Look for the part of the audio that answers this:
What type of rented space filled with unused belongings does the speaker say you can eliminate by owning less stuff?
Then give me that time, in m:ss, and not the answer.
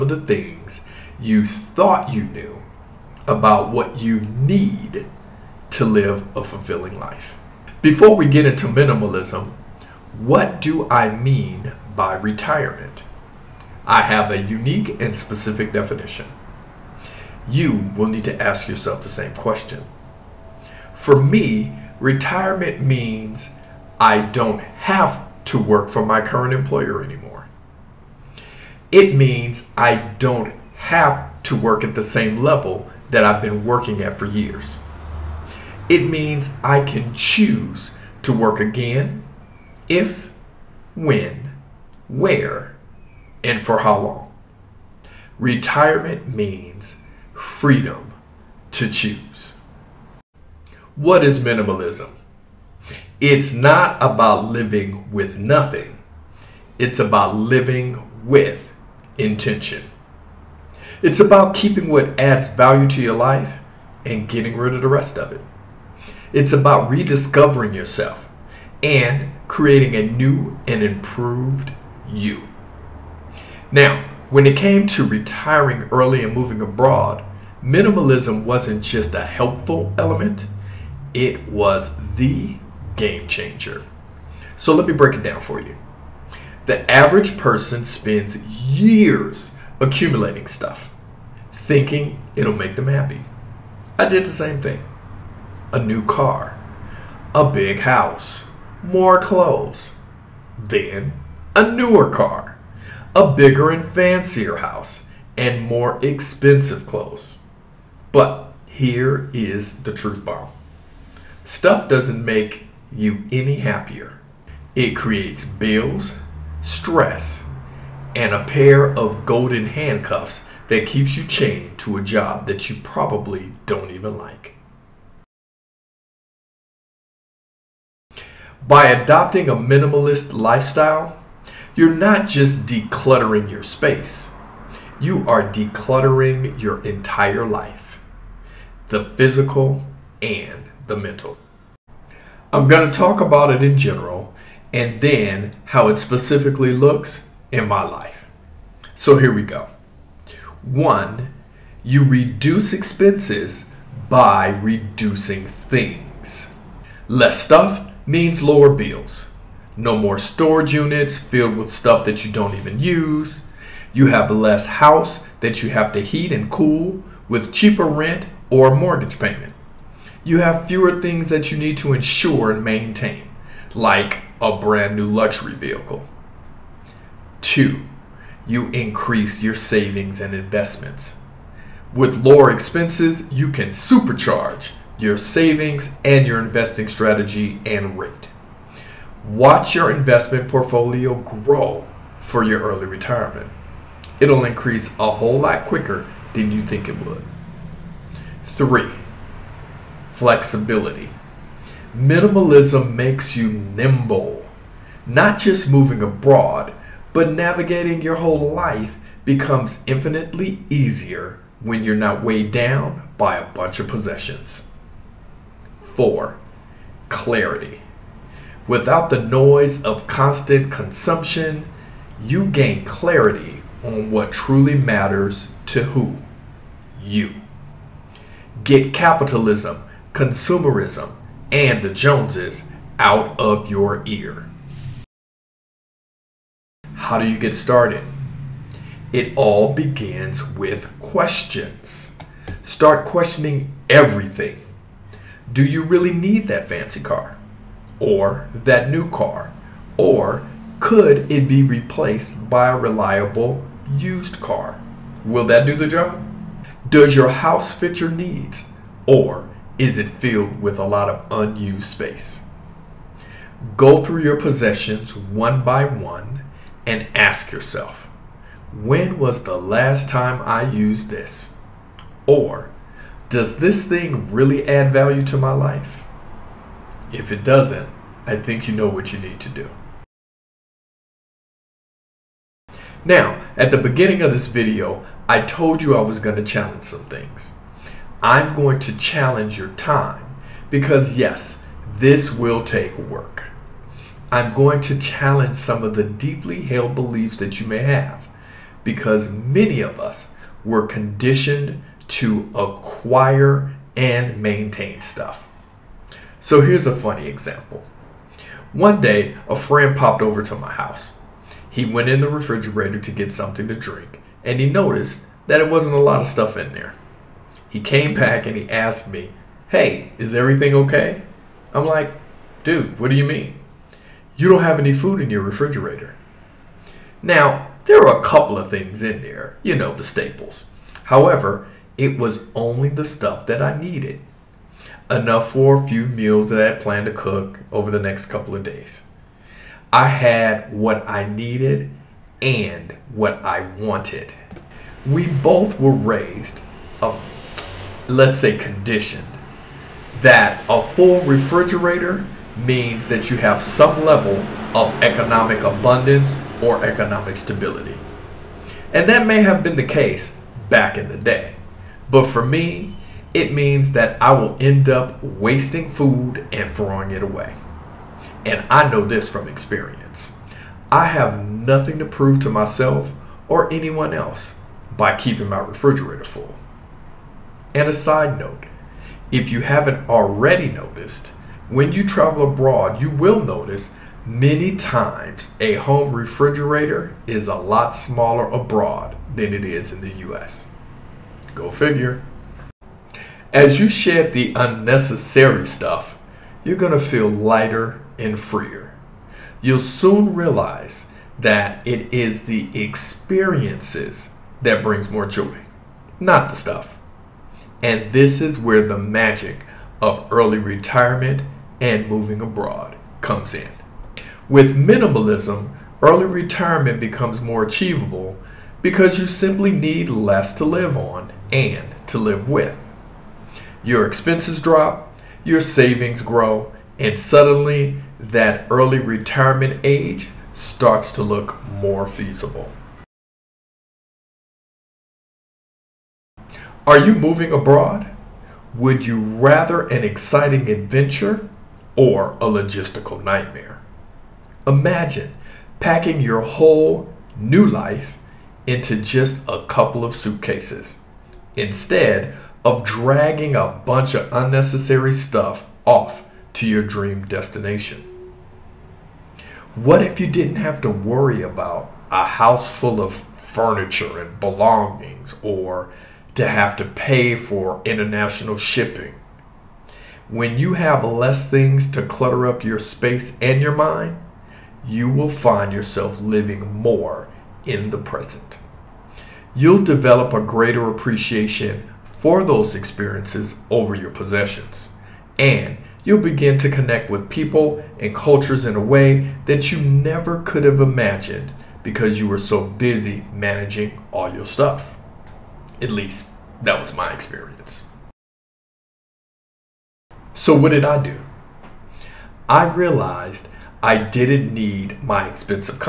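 2:40.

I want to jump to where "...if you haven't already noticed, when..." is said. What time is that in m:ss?
6:19.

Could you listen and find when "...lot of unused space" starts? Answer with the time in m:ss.
4:20.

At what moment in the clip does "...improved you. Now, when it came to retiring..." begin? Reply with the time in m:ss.
1:10.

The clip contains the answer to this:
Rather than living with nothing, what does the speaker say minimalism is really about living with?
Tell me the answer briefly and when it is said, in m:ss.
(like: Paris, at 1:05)
intention, at 0:59.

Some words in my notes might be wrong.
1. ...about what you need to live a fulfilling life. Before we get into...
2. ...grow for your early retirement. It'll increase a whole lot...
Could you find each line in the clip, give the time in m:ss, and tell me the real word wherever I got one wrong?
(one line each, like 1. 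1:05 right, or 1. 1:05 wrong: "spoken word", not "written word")
1. 0:03 right
2. 3:11 right.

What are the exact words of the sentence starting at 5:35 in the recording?
Enough for a few meals that I had planned to cook over the next couple of days.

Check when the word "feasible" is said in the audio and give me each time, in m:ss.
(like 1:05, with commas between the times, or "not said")
7:12.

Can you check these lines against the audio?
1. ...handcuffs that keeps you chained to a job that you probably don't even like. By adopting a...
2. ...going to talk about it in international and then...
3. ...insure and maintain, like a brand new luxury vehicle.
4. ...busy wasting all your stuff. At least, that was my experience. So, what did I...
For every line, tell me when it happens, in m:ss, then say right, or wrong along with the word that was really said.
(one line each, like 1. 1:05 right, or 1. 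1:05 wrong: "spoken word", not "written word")
1. 1:59 right
2. 2:22 wrong: "general", not "international"
3. 2:51 right
4. 8:12 wrong: "managing", not "wasting".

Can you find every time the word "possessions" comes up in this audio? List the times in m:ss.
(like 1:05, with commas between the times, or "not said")
3:33, 4:24, 8:04.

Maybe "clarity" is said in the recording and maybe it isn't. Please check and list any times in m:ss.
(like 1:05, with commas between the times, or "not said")
3:37, 3:42.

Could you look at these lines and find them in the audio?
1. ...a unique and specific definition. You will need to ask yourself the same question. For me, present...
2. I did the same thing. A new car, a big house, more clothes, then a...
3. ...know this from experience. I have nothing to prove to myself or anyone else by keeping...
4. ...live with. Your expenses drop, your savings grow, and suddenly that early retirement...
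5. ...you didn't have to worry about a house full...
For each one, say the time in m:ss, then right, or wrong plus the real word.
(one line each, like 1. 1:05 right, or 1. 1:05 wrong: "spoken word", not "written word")
1. 0:14 wrong: "retirement", not "present"
2. 1:33 right
3. 6:08 right
4. 7:02 right
5. 7:40 right.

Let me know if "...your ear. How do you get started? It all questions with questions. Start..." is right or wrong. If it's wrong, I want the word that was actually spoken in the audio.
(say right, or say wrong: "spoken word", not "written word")
wrong: "begins", not "questions".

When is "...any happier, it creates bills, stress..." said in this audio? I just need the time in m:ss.
1:53.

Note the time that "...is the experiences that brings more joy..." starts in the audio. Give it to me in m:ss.
6:42.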